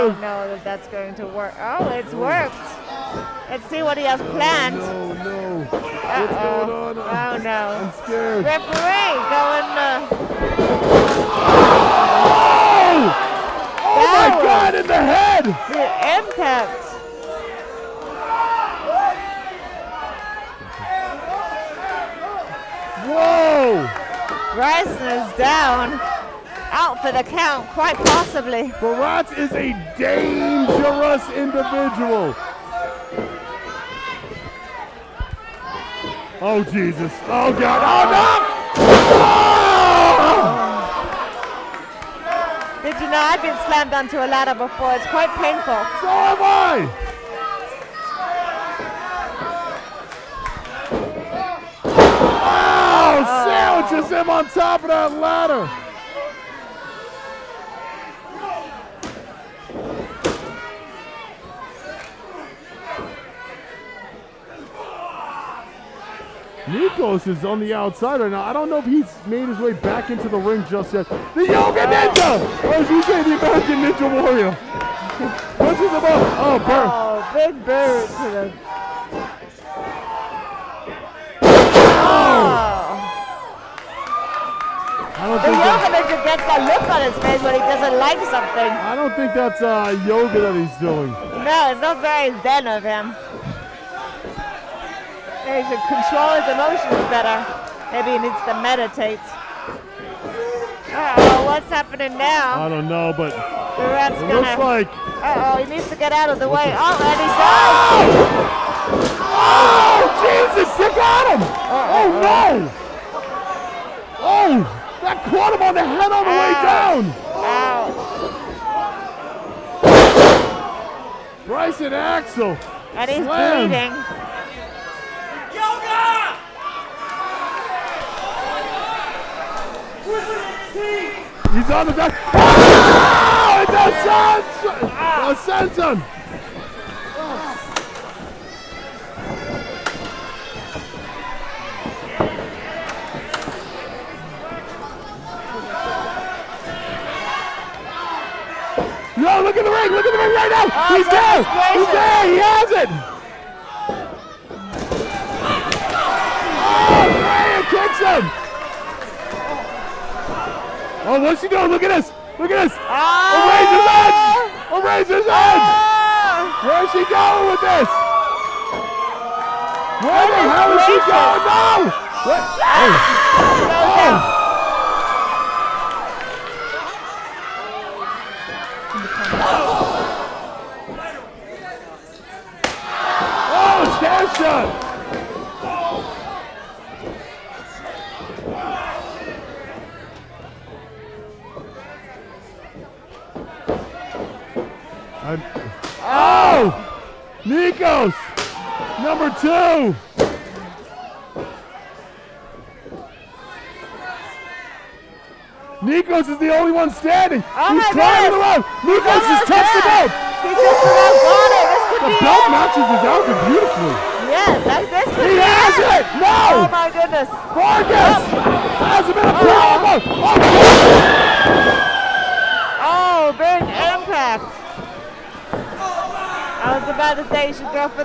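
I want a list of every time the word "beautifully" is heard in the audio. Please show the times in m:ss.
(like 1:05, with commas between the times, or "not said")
3:33.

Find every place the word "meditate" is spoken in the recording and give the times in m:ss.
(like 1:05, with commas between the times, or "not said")
1:38.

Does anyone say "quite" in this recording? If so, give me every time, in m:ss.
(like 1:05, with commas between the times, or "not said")
0:27, 0:45.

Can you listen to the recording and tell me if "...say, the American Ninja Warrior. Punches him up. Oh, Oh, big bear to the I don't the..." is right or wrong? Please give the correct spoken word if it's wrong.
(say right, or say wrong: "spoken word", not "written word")
right.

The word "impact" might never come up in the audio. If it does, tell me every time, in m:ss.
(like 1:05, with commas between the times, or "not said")
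0:16, 3:43.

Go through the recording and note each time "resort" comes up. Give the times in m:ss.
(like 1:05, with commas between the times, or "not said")
not said.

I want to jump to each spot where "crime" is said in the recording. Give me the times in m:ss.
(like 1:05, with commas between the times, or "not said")
not said.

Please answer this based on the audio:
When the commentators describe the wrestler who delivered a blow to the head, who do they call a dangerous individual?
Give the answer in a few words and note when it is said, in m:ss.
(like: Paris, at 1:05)
Baratz, at 0:28.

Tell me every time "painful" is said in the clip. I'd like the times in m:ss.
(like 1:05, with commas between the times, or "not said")
0:45.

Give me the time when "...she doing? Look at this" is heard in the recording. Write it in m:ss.
2:41.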